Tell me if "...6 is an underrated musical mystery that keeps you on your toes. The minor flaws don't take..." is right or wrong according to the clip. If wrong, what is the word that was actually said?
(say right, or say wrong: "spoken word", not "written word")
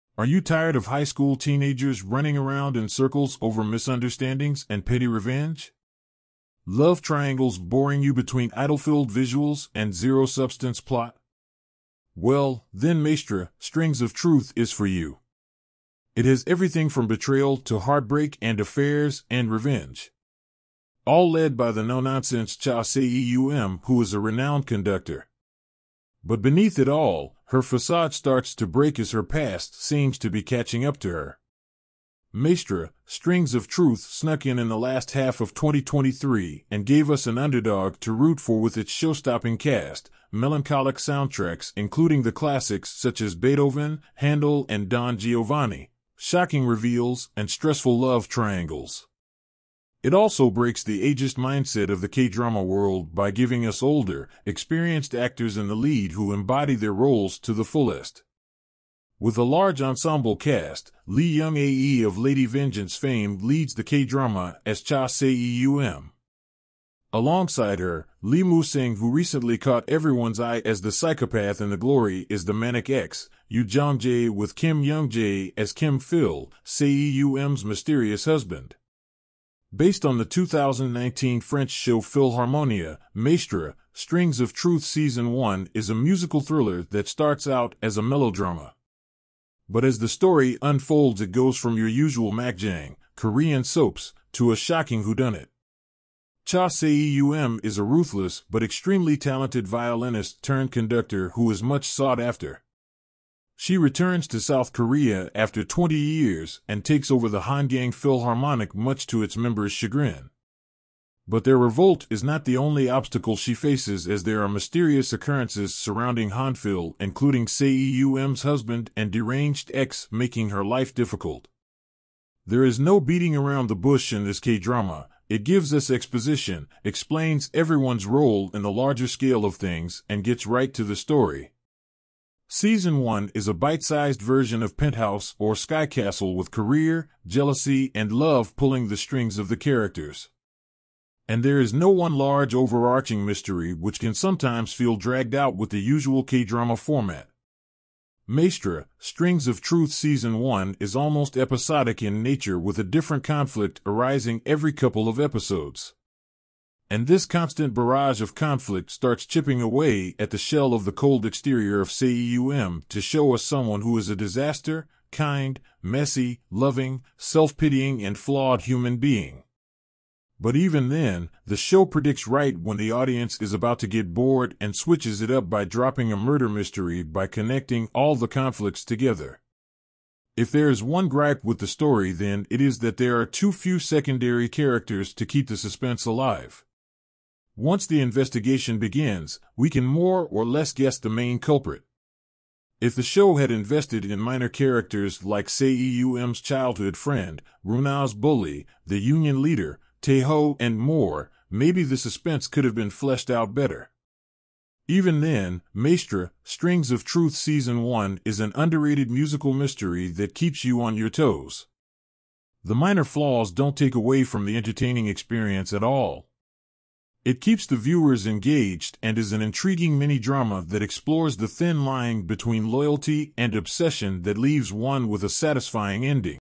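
wrong: "1", not "6".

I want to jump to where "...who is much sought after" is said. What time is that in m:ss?
1:41.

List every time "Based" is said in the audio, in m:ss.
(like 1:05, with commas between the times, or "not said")
1:19.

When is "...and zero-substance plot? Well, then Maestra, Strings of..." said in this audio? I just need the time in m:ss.
0:09.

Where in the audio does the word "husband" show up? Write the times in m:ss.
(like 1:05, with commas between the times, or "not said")
1:18, 1:58.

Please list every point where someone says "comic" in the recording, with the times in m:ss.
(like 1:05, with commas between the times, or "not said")
not said.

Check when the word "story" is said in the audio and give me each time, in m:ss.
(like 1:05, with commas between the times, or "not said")
1:30, 2:10, 3:01.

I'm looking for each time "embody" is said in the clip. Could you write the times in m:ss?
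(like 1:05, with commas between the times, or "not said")
0:56.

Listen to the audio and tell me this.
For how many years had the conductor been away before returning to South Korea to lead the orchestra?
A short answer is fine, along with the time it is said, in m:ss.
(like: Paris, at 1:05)
20, at 1:45.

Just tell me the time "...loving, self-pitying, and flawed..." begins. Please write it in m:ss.
2:46.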